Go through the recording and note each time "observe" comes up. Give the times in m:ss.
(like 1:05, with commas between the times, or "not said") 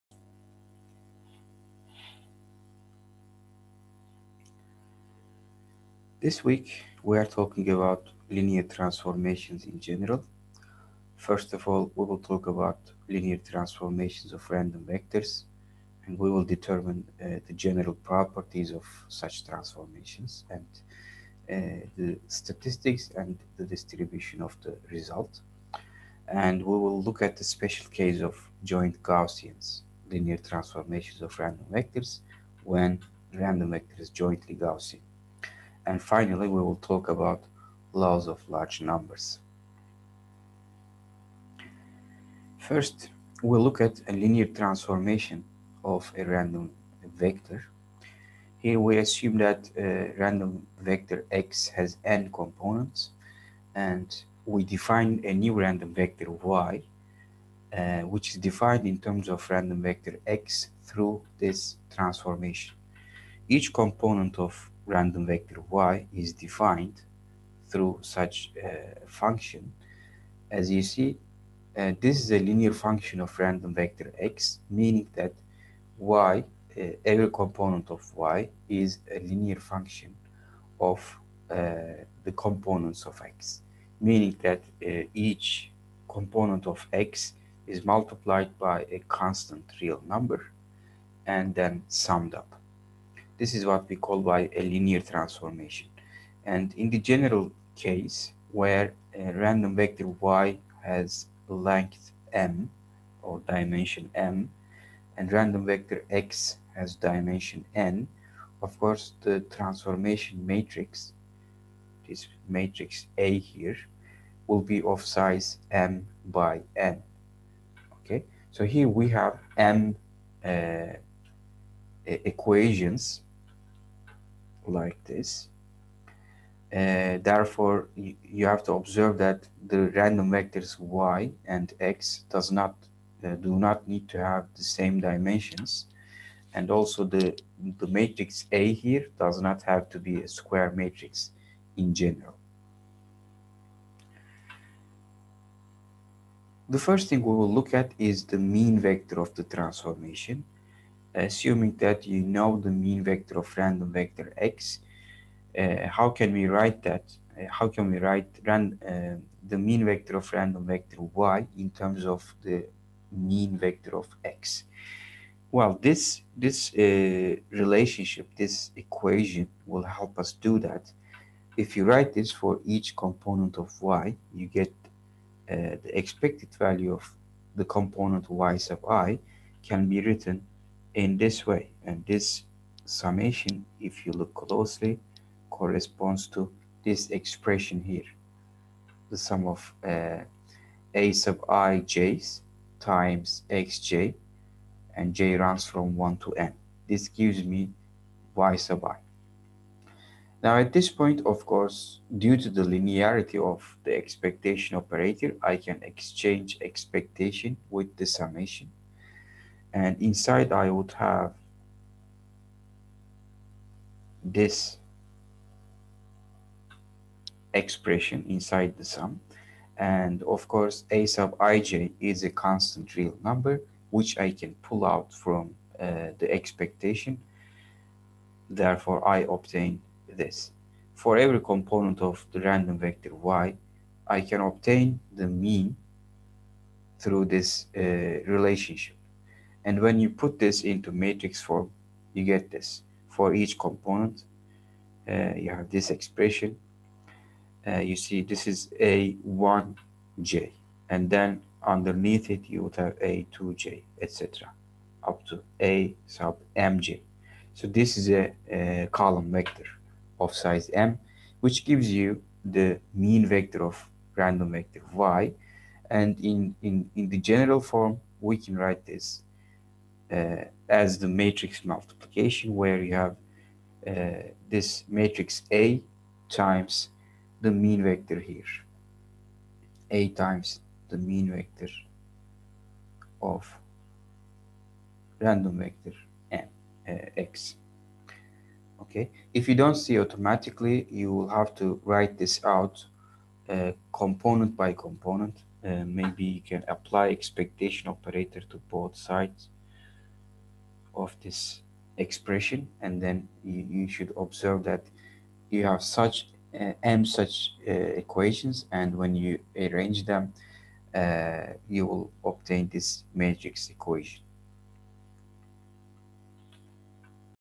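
2:08, 5:04.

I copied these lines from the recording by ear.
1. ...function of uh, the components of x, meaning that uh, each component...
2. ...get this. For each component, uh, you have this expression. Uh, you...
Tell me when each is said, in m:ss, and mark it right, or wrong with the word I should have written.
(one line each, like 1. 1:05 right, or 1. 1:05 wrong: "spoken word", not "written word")
1. 1:19 right
2. 4:02 right.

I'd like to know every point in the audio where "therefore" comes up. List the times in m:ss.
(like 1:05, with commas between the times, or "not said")
2:07, 3:48.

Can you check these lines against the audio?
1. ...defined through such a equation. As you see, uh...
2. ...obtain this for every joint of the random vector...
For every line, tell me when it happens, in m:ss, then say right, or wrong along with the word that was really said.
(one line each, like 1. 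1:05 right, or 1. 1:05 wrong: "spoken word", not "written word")
1. 1:06 wrong: "function", not "equation"
2. 3:49 wrong: "component", not "joint".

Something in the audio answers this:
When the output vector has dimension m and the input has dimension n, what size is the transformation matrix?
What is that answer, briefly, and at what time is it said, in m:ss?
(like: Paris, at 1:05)
m by n, at 1:55.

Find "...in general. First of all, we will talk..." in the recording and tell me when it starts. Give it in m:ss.
0:09.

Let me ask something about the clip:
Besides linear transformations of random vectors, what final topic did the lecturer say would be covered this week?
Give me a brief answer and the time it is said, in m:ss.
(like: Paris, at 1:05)
laws of large numbers, at 0:37.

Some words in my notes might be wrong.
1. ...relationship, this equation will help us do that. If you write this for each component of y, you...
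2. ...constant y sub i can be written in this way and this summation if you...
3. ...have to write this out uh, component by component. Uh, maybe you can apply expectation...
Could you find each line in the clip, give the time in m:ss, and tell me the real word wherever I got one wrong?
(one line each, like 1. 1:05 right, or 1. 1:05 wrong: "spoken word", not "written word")
1. 2:47 right
2. 2:57 wrong: "component", not "constant"
3. 4:51 right.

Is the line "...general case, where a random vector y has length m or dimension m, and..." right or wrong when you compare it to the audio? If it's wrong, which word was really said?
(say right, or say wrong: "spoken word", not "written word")
right.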